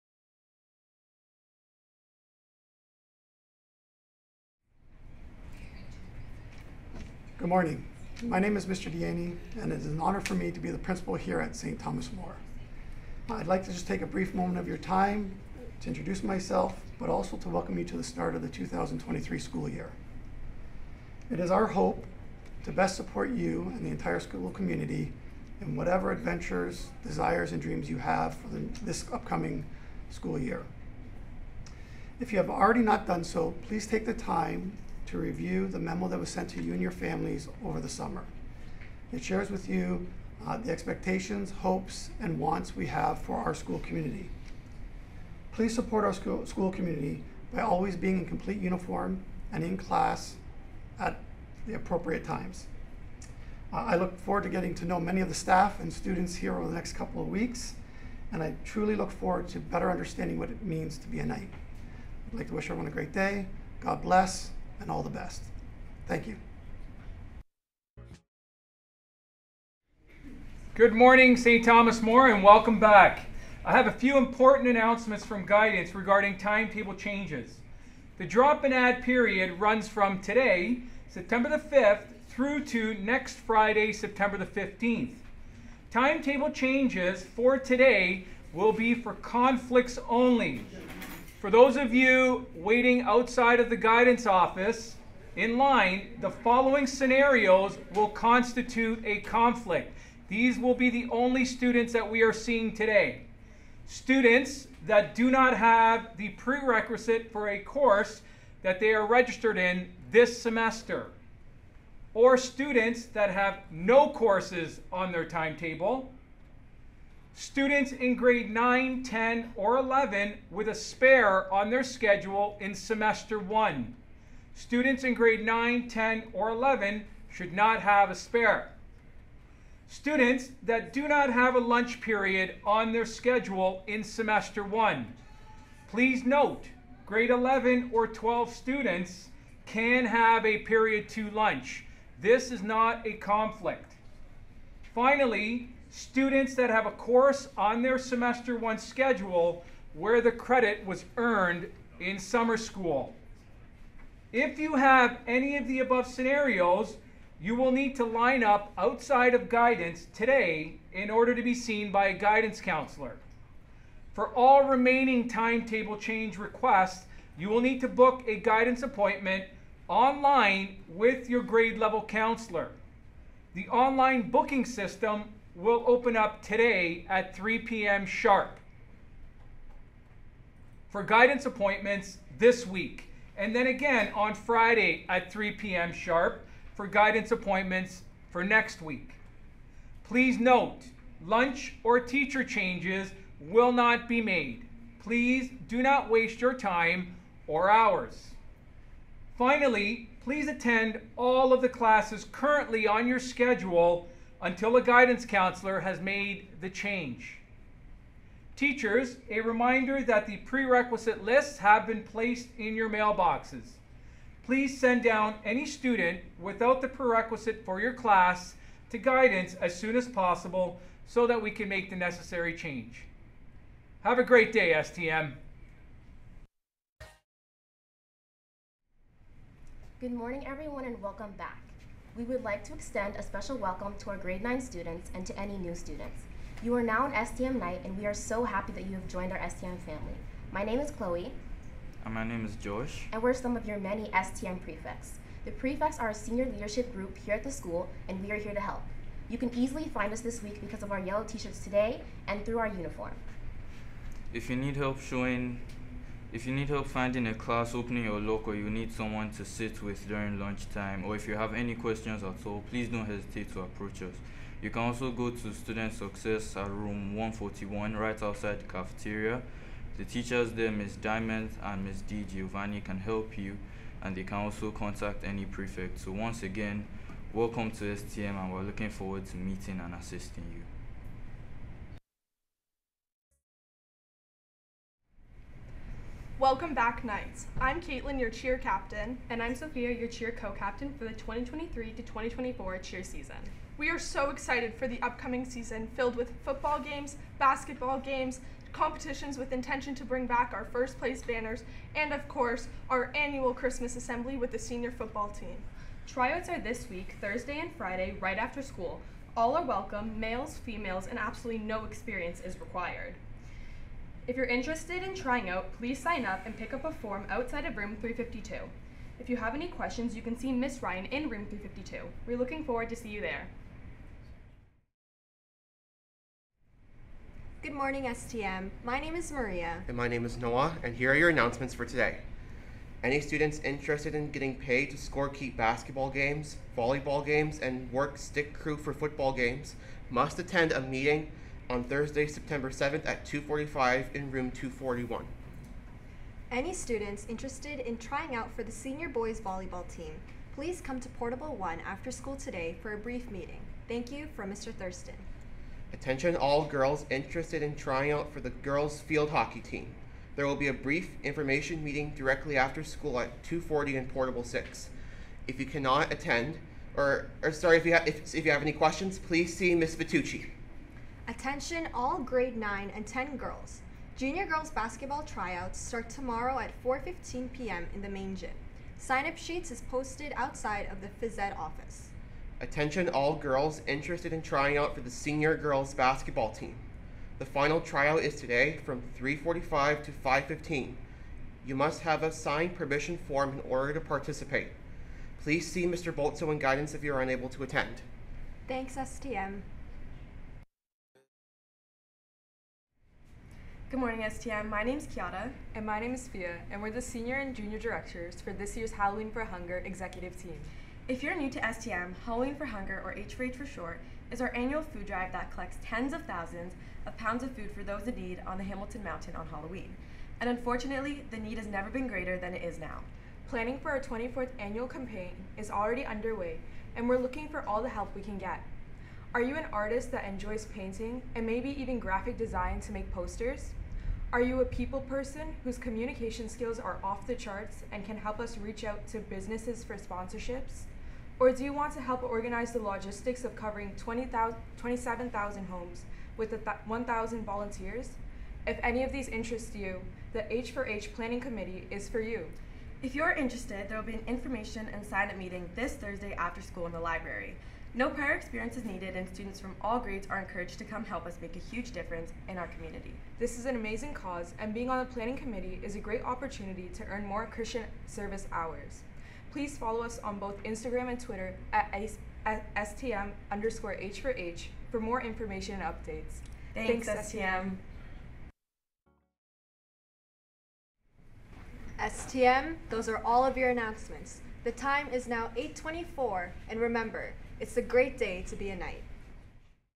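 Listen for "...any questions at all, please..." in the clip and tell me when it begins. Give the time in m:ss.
4:21.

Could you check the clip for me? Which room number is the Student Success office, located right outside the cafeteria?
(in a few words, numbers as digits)
141.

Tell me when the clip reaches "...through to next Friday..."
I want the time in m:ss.
1:22.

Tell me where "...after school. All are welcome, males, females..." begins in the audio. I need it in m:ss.
5:08.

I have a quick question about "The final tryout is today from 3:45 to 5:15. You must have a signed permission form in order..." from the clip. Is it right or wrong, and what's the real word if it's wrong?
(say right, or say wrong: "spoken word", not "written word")
right.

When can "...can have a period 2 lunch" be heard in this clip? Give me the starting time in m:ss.
2:19.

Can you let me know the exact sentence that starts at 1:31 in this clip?
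For those of you waiting outside of the guidance office in line, the following scenarios will constitute a conflict.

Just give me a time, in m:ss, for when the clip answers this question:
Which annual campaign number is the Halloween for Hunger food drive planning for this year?
7:03.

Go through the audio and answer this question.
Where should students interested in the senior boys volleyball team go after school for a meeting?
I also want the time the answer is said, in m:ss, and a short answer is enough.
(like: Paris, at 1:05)
Portable 1, at 5:51.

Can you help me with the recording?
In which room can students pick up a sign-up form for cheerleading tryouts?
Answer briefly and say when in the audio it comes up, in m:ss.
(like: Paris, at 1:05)
352, at 5:17.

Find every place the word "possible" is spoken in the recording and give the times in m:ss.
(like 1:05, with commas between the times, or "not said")
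3:40.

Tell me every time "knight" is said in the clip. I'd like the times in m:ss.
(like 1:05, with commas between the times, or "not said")
1:01, 3:57, 4:47, 8:08.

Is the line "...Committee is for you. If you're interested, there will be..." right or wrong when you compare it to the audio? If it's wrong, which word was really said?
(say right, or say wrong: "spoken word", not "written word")
right.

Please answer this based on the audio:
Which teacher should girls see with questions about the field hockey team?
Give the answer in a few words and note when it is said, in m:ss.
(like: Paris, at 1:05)
Ms. Vitucci, at 6:09.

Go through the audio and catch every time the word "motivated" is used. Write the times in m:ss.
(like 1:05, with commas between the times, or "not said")
not said.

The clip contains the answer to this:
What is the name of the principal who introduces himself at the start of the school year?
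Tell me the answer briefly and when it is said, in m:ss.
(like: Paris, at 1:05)
Mr. Deaney, at 0:08.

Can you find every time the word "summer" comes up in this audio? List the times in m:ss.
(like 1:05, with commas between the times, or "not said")
0:37, 2:32.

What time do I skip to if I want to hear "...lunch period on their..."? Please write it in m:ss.
2:11.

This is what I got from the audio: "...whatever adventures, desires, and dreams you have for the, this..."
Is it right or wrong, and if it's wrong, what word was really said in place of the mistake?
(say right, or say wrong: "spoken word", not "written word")
right.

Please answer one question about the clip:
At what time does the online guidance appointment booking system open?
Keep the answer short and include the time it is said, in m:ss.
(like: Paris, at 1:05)
3 p.m., at 2:57.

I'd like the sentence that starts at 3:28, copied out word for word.
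Teachers, a reminder that the prerequisite lists have been placed in your mailboxes.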